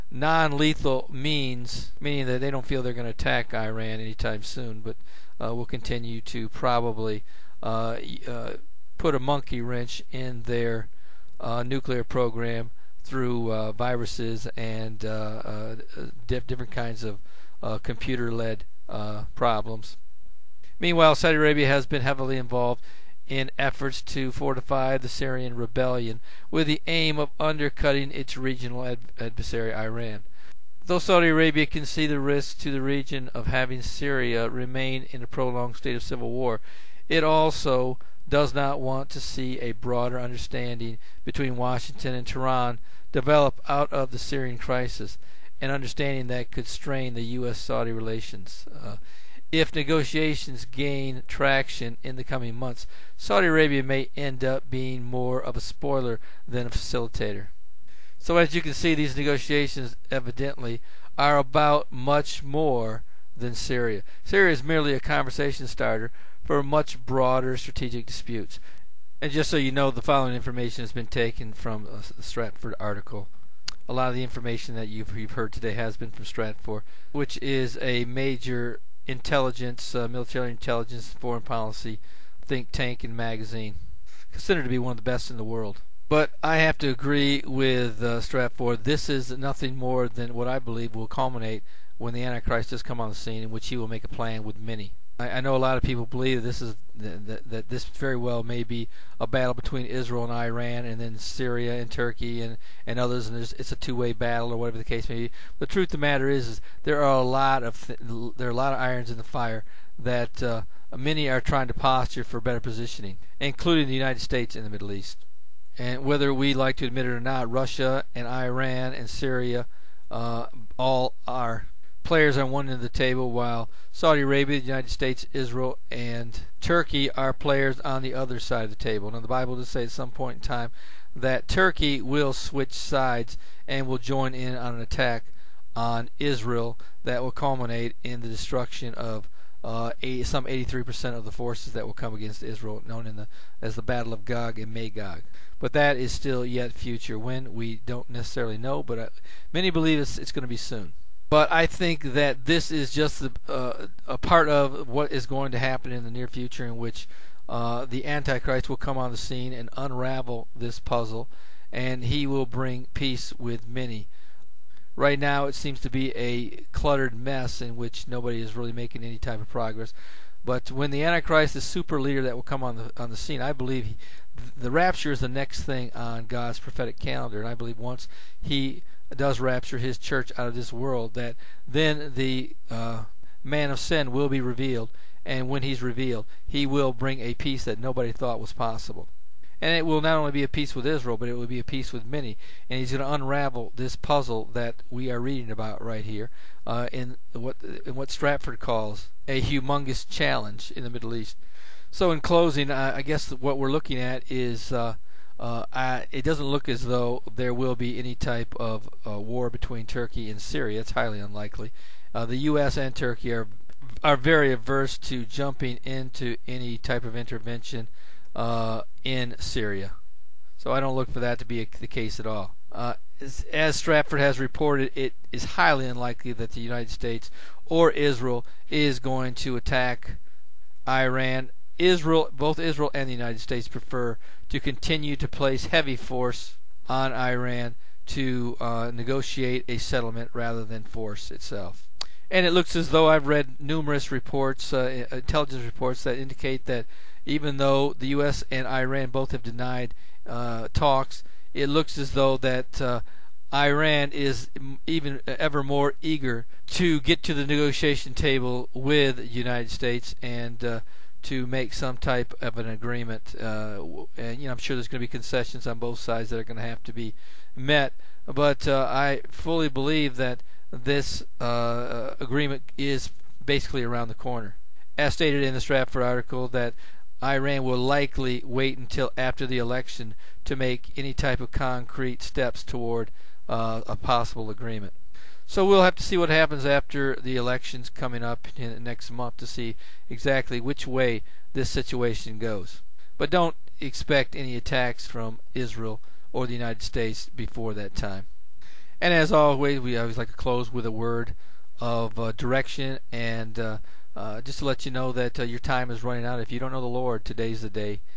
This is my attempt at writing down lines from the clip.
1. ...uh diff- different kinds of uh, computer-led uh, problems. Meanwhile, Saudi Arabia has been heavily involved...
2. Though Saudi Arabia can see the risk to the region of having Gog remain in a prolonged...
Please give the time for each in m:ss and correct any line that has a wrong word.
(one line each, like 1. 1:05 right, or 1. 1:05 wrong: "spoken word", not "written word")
1. 0:15 right
2. 0:30 wrong: "Syria", not "Gog".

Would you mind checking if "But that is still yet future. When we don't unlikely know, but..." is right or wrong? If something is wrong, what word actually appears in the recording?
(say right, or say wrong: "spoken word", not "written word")
wrong: "necessarily", not "unlikely".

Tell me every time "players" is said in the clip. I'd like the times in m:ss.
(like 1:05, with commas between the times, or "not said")
2:02, 2:07.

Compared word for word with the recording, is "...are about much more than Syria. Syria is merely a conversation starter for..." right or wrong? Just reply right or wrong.
right.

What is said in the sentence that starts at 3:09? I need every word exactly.
And it will not only be a peace with Israel, but it will be a peace with many.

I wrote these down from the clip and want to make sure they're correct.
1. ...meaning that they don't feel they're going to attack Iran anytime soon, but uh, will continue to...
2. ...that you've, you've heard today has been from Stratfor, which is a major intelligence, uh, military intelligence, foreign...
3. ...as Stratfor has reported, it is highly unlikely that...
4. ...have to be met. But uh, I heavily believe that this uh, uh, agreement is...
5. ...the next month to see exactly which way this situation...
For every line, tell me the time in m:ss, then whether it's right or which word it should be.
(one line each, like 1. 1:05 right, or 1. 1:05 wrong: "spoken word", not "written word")
1. 0:02 right
2. 1:14 right
3. 3:43 right
4. 4:26 wrong: "fully", not "heavily"
5. 4:48 right.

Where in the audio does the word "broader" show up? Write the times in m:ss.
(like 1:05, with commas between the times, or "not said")
0:39, 1:07.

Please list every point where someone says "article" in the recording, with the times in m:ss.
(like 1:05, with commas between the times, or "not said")
1:12, 4:36.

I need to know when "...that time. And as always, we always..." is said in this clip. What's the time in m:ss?
4:57.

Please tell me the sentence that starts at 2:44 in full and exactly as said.
Right now, it seems to be a cluttered mess in which nobody is really making any type of progress.